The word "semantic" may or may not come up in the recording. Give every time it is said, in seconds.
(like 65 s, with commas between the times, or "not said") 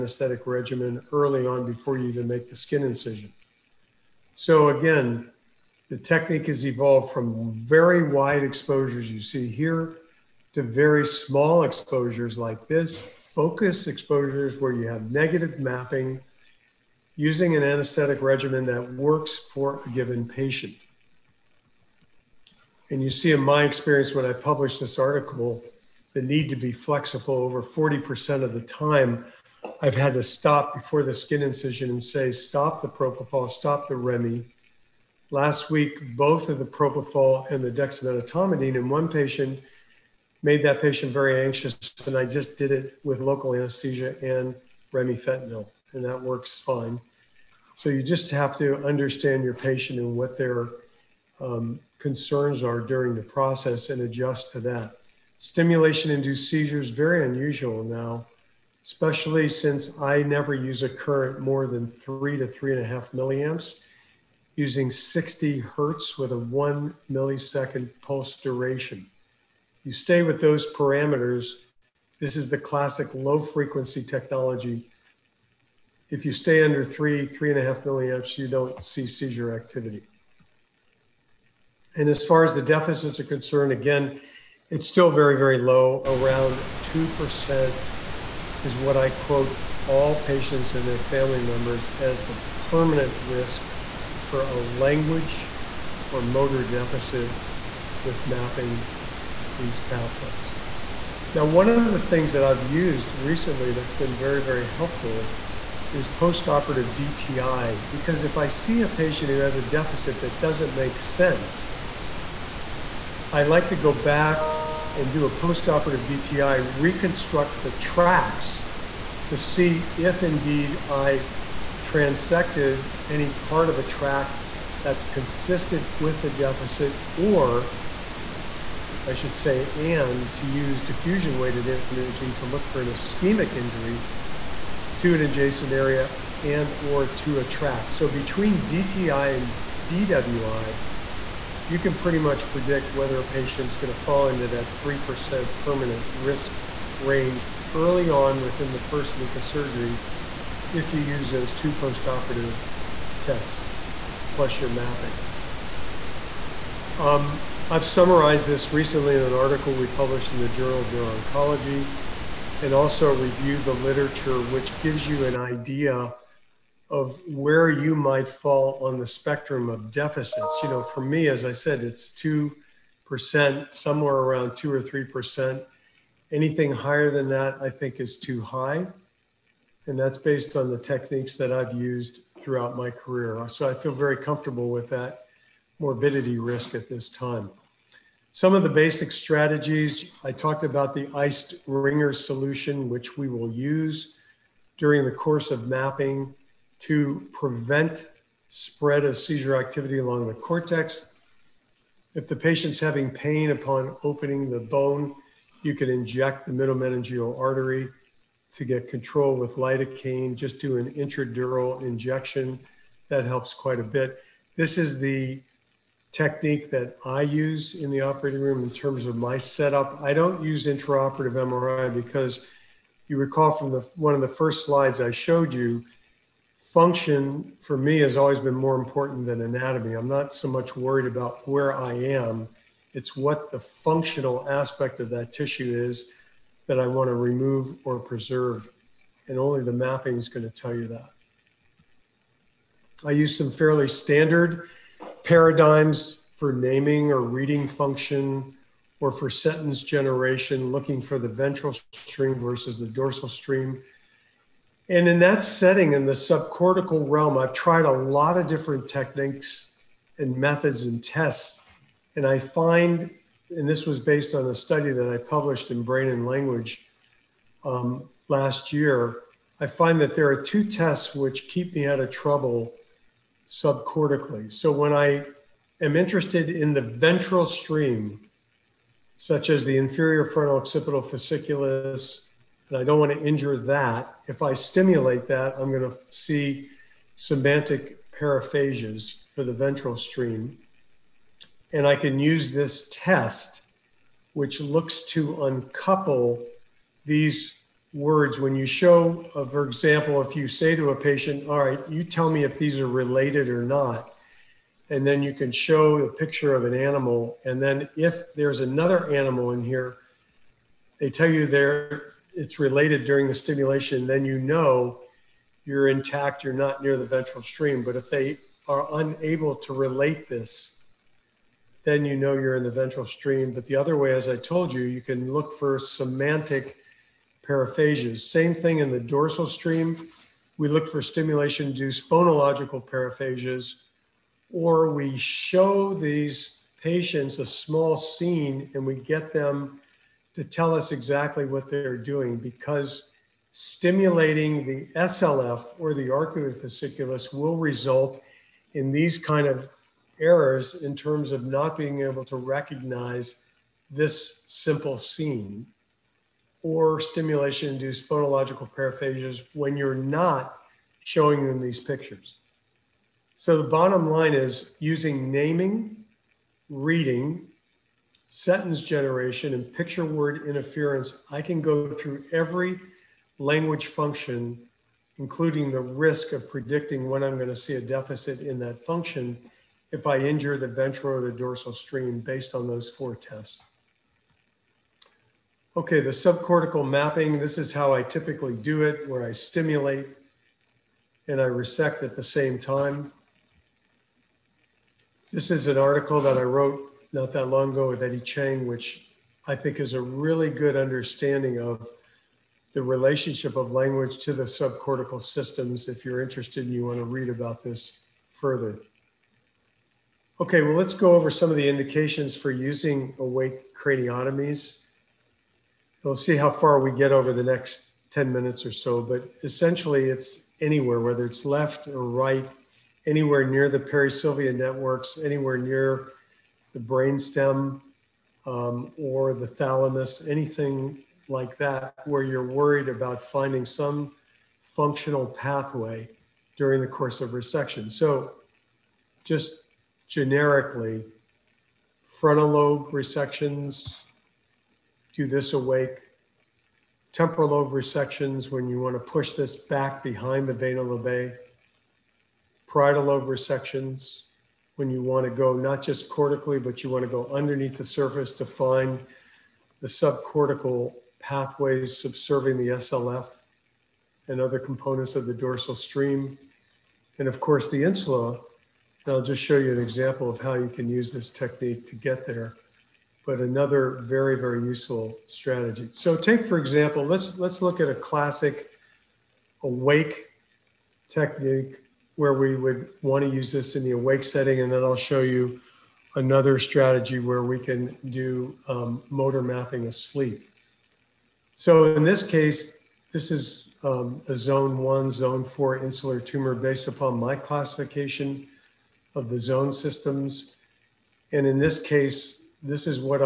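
287 s, 325 s.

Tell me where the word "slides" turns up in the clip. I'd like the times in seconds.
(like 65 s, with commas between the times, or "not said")
224 s.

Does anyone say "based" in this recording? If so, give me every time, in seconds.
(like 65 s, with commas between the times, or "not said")
180 s, 263 s, 382 s, 496 s.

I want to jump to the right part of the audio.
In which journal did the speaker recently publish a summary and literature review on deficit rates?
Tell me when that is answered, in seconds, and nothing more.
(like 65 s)
160 s.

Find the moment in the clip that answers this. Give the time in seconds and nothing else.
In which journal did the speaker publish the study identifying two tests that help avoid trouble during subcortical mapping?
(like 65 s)
265 s.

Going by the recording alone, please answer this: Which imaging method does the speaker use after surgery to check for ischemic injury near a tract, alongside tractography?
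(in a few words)
diffusion weighted imaging.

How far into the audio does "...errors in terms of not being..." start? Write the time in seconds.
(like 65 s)
350 s.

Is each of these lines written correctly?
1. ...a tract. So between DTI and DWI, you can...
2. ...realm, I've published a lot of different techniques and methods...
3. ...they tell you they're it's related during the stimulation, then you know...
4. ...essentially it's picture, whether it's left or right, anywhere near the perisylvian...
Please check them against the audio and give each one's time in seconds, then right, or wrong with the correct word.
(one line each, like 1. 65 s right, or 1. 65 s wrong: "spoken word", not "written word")
1. 137 s right
2. 257 s wrong: "tried", not "published"
3. 310 s right
4. 419 s wrong: "anywhere", not "picture".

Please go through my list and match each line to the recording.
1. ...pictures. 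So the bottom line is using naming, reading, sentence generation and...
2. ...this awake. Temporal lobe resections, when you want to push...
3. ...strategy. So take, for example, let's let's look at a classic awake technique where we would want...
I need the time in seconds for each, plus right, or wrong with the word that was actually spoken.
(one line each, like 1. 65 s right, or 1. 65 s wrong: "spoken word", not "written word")
1. 361 s right
2. 445 s right
3. 475 s right.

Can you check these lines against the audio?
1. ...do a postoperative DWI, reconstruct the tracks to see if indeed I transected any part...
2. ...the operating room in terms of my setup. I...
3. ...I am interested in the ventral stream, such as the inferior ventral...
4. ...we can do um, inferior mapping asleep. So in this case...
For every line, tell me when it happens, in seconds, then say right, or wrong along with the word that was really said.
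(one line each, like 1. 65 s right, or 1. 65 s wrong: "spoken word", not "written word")
1. 115 s wrong: "DTI", not "DWI"
2. 217 s right
3. 274 s wrong: "frontal", not "ventral"
4. 487 s wrong: "motor", not "inferior".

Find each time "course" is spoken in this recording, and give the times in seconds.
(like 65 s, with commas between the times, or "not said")
195 s, 436 s, 467 s.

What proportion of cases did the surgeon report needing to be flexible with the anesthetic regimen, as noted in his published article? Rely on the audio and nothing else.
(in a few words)
over 40%.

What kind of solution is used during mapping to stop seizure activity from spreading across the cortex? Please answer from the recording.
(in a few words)
iced Ringer solution.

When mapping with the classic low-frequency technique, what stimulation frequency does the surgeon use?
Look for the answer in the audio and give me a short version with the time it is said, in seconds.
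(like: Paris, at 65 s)
60 hertz, at 64 s.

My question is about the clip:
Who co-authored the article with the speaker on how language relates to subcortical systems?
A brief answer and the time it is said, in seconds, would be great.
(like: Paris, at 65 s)
Eddie Chang, at 398 s.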